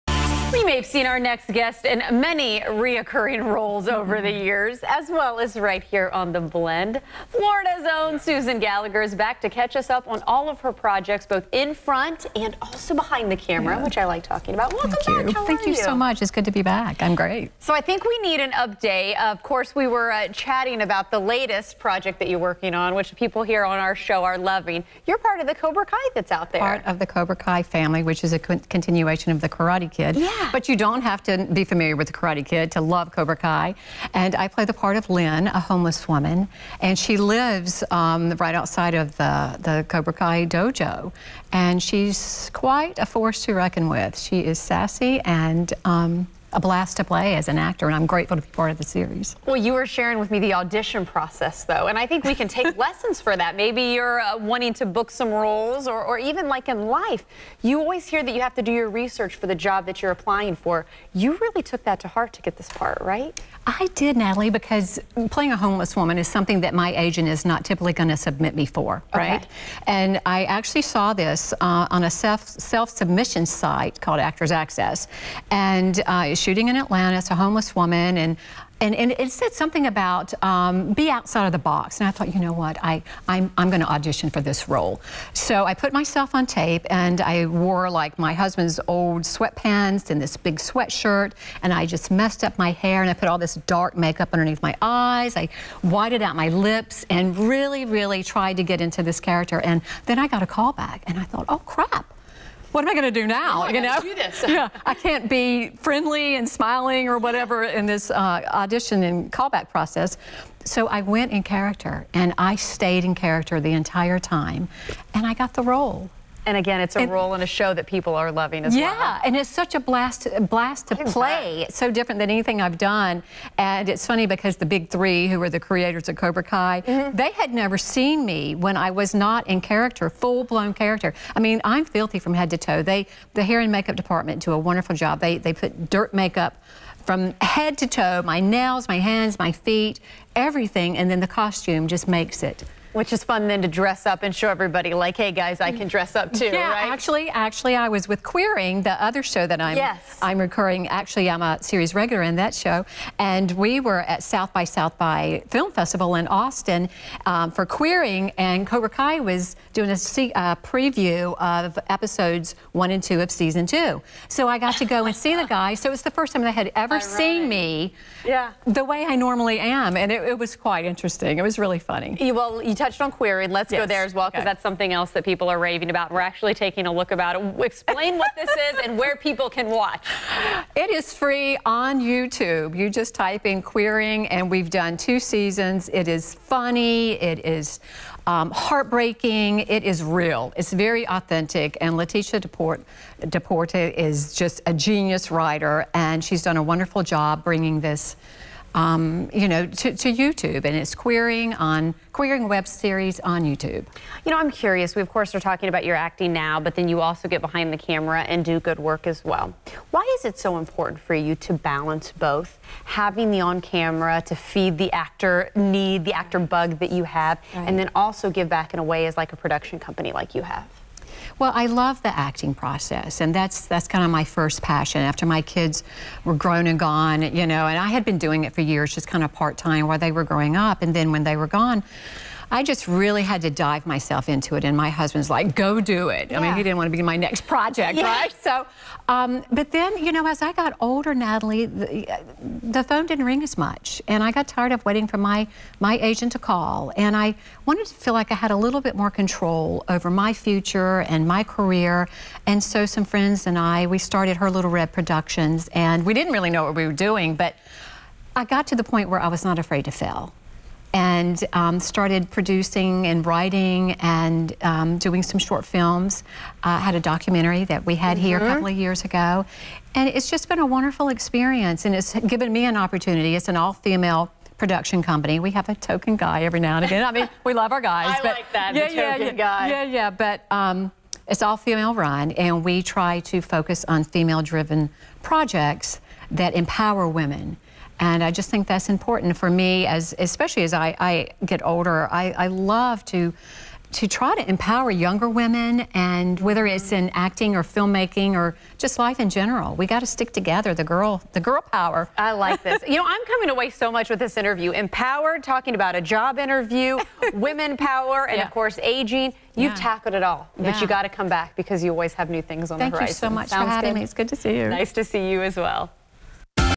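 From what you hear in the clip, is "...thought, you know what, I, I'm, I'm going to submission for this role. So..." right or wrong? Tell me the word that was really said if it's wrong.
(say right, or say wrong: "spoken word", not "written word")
wrong: "audition", not "submission".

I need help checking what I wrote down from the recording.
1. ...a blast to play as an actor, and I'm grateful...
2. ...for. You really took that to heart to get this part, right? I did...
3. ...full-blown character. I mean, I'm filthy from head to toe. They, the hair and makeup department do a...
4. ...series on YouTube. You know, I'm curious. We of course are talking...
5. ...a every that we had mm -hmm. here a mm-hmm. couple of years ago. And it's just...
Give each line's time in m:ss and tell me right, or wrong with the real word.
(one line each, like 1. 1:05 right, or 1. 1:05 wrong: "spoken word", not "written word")
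1. 0:46 right
2. 1:00 right
3. 2:10 right
4. 3:22 right
5. 4:26 wrong: "documentary", not "every".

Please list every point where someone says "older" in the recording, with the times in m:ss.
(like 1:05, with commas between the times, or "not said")
4:00, 4:51.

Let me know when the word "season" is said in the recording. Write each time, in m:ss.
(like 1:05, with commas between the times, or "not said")
2:43, 3:05.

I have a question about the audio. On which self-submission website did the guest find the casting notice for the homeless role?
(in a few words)
Actors Access.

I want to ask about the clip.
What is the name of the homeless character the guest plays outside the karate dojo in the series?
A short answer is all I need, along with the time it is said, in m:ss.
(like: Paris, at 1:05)
Lynn, at 0:35.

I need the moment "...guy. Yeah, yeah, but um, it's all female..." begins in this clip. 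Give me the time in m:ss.
4:39.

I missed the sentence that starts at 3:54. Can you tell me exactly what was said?
And my husband's like, go do it.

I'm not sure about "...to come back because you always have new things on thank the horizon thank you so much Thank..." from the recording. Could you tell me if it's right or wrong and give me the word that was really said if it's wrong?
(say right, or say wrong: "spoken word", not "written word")
wrong: "Sounds", not "Thank".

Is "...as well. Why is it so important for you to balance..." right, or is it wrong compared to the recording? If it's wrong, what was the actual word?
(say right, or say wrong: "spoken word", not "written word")
right.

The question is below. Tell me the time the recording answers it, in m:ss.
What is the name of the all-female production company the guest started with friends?
4:14.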